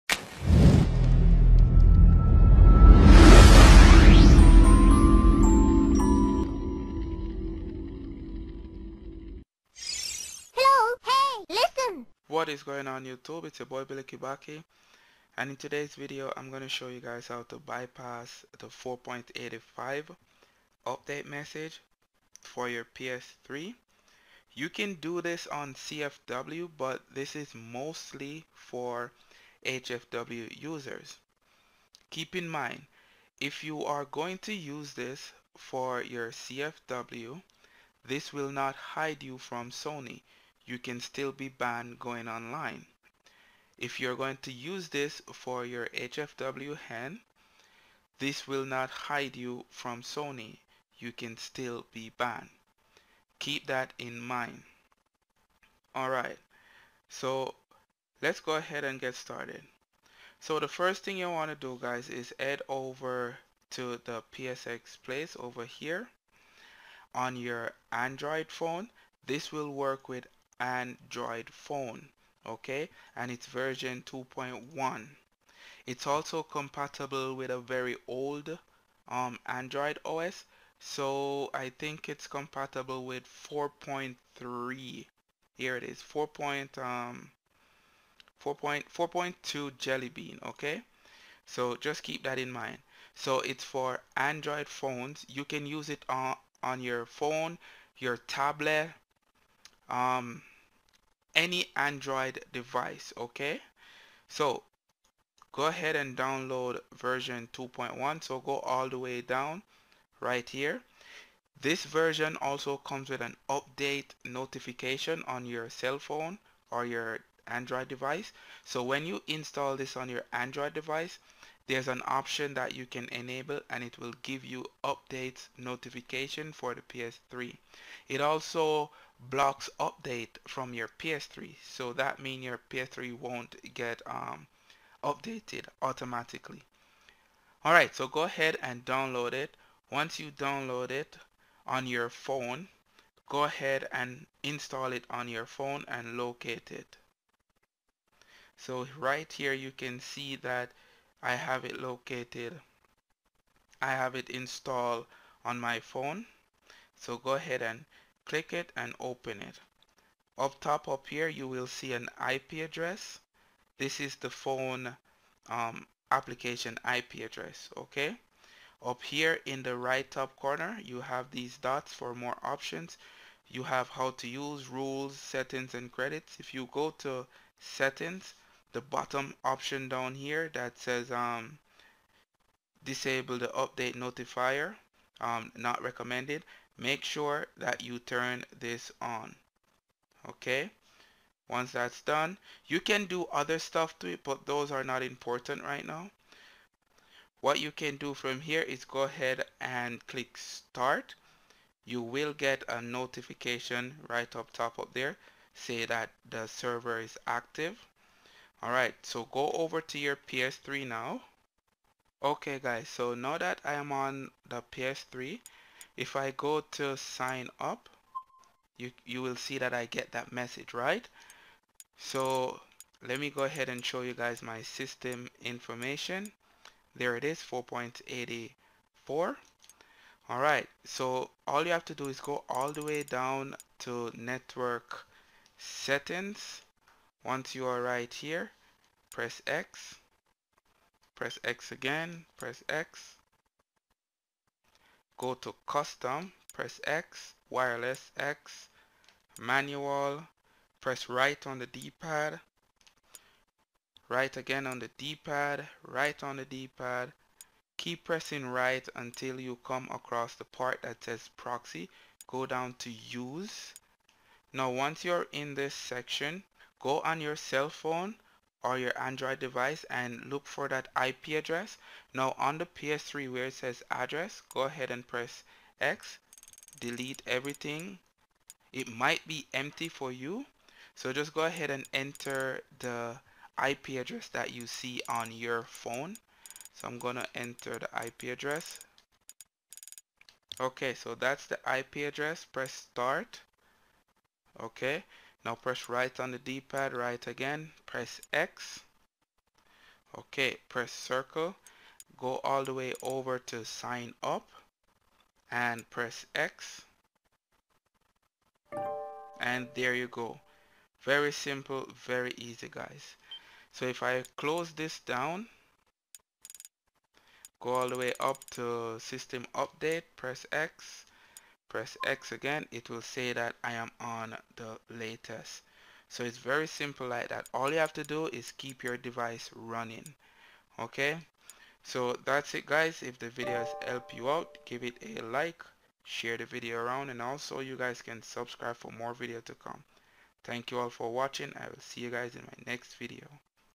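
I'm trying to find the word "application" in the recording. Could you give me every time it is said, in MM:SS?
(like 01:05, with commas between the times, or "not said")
02:46.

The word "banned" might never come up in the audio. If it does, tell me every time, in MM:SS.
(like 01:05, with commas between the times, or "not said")
00:41, 00:52.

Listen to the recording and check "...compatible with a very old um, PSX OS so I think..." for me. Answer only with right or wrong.
wrong.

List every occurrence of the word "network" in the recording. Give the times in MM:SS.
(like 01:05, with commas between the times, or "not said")
03:54.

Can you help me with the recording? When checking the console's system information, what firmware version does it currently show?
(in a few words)
4.84.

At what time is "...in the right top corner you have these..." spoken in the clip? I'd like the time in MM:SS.
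02:49.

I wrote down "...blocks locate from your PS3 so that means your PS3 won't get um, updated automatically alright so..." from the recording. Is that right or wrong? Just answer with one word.
wrong.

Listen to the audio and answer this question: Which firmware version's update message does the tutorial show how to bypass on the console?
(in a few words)
4.85.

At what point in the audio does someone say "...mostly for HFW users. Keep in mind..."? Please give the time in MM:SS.
00:27.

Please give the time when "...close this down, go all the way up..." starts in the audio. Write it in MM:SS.
05:14.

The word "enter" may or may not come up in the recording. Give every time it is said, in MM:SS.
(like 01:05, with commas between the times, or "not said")
04:41, 04:47.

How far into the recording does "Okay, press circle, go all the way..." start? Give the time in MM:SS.
05:00.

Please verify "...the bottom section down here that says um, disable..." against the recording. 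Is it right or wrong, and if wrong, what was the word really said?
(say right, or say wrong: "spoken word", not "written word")
wrong: "option", not "section".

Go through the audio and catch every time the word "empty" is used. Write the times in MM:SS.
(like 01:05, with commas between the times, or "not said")
04:39.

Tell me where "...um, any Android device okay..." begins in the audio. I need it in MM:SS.
01:39.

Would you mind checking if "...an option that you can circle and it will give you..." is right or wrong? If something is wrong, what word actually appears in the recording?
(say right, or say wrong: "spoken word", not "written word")
wrong: "enable", not "circle".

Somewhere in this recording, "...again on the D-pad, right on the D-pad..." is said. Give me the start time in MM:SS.
04:14.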